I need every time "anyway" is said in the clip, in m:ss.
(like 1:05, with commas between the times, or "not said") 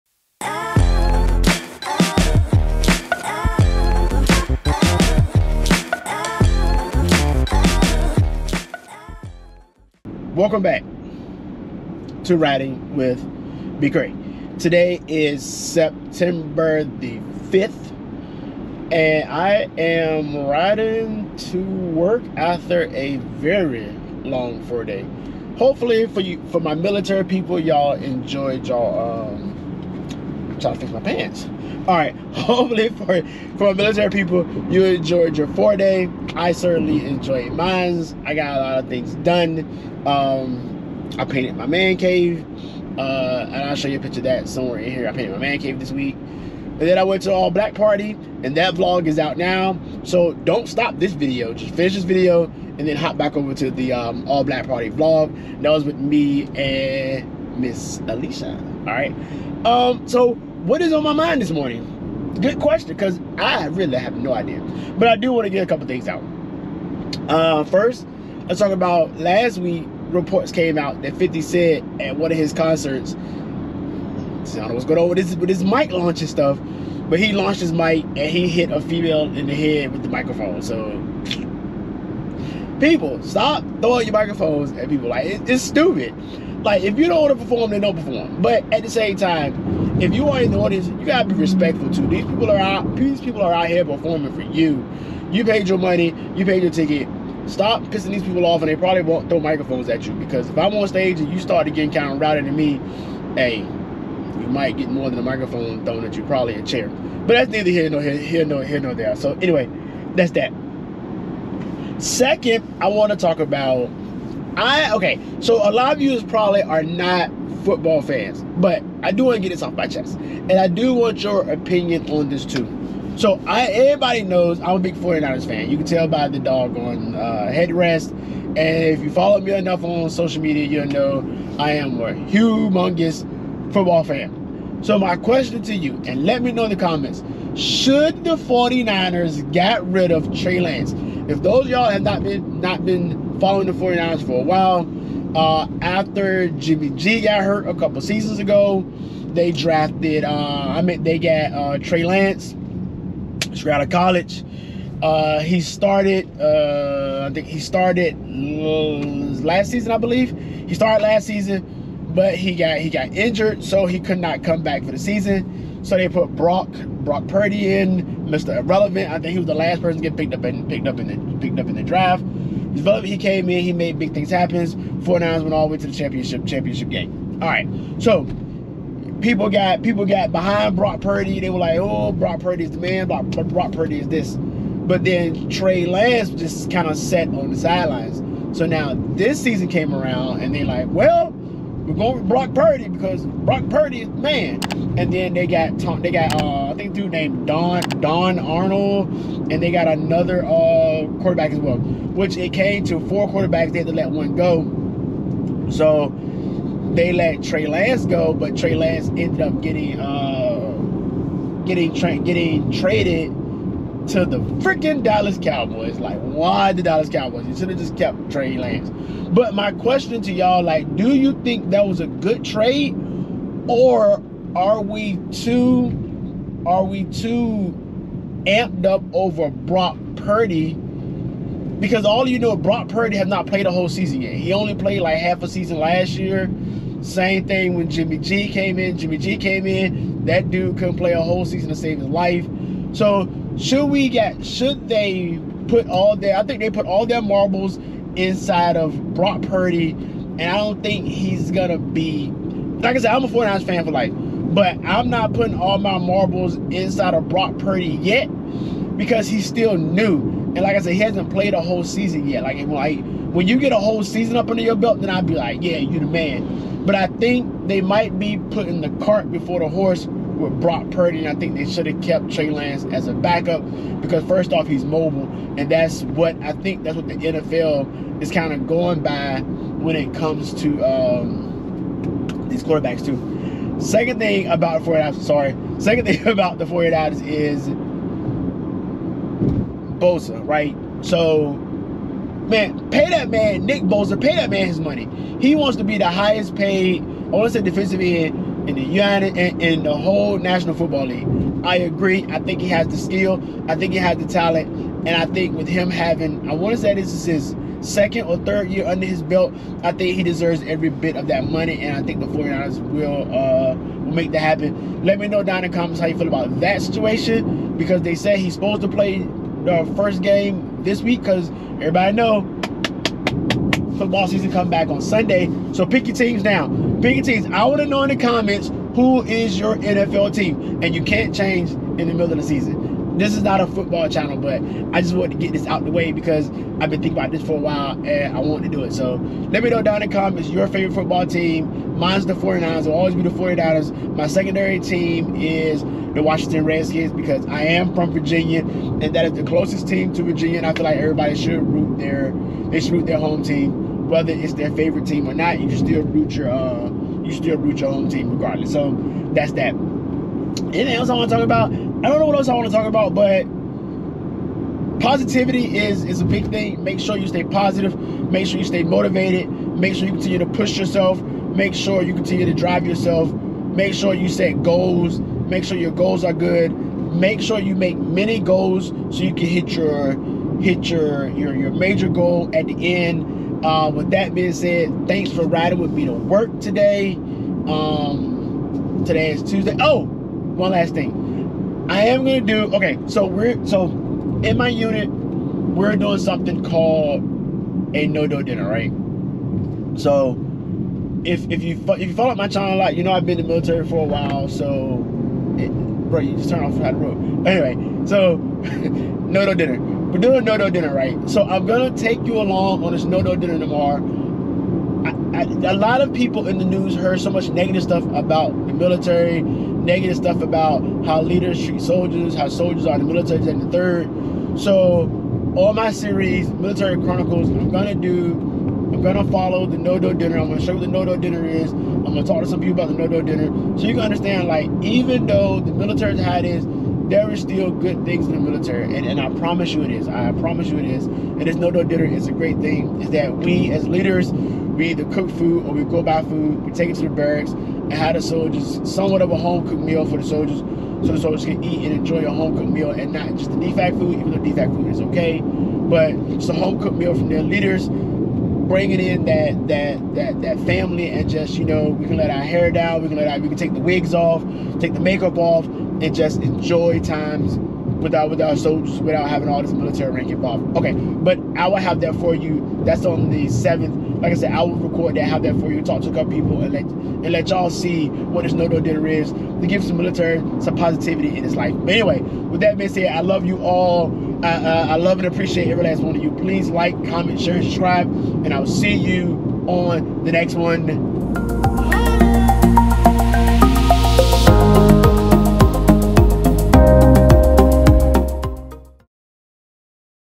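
1:49, 6:47, 8:01.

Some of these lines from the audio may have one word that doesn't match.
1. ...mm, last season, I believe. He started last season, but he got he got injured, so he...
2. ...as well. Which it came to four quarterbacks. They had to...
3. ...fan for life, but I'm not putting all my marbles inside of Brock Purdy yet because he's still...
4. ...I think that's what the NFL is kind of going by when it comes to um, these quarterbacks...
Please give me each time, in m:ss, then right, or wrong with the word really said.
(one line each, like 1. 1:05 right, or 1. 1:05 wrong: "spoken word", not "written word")
1. 2:38 right
2. 3:21 right
3. 4:13 right
4. 4:36 right.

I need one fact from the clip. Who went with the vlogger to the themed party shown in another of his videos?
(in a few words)
Miss Alicia.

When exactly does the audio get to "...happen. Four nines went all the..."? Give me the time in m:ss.
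2:54.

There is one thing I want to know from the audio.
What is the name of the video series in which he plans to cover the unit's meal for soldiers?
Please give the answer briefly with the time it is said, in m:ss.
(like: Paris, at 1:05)
Military Chronicles, at 7:06.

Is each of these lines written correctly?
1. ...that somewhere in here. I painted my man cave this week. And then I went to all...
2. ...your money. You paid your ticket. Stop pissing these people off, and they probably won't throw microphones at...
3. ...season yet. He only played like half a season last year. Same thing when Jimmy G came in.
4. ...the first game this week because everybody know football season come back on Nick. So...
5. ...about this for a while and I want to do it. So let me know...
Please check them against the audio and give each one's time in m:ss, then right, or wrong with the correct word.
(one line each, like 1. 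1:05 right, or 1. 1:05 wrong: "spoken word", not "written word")
1. 0:44 right
2. 1:35 right
3. 3:53 right
4. 5:19 wrong: "Sunday", not "Nick"
5. 5:37 right.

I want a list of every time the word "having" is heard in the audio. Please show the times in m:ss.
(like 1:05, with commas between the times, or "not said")
5:05, 7:49.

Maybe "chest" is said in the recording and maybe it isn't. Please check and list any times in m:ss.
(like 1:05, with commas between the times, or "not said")
1:59.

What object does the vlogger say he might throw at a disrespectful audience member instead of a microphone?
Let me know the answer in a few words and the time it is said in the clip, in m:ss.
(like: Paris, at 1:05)
a chair, at 1:46.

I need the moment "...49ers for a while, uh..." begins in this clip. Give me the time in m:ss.
2:23.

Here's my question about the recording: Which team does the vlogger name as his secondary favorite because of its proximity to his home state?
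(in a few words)
Washington Redskins.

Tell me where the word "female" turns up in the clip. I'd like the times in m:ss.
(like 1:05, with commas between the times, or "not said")
1:18.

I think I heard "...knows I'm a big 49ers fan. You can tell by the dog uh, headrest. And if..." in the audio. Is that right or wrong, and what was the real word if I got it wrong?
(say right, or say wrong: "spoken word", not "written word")
right.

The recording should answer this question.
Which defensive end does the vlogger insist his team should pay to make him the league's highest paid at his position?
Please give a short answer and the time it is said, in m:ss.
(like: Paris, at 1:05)
Nick Bosa, at 4:53.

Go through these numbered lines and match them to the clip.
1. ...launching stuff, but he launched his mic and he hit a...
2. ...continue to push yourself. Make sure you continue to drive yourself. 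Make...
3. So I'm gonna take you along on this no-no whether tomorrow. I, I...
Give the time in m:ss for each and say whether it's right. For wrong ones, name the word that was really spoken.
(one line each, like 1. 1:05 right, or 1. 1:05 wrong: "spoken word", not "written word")
1. 1:15 right
2. 6:10 right
3. 6:51 wrong: "dinner", not "whether".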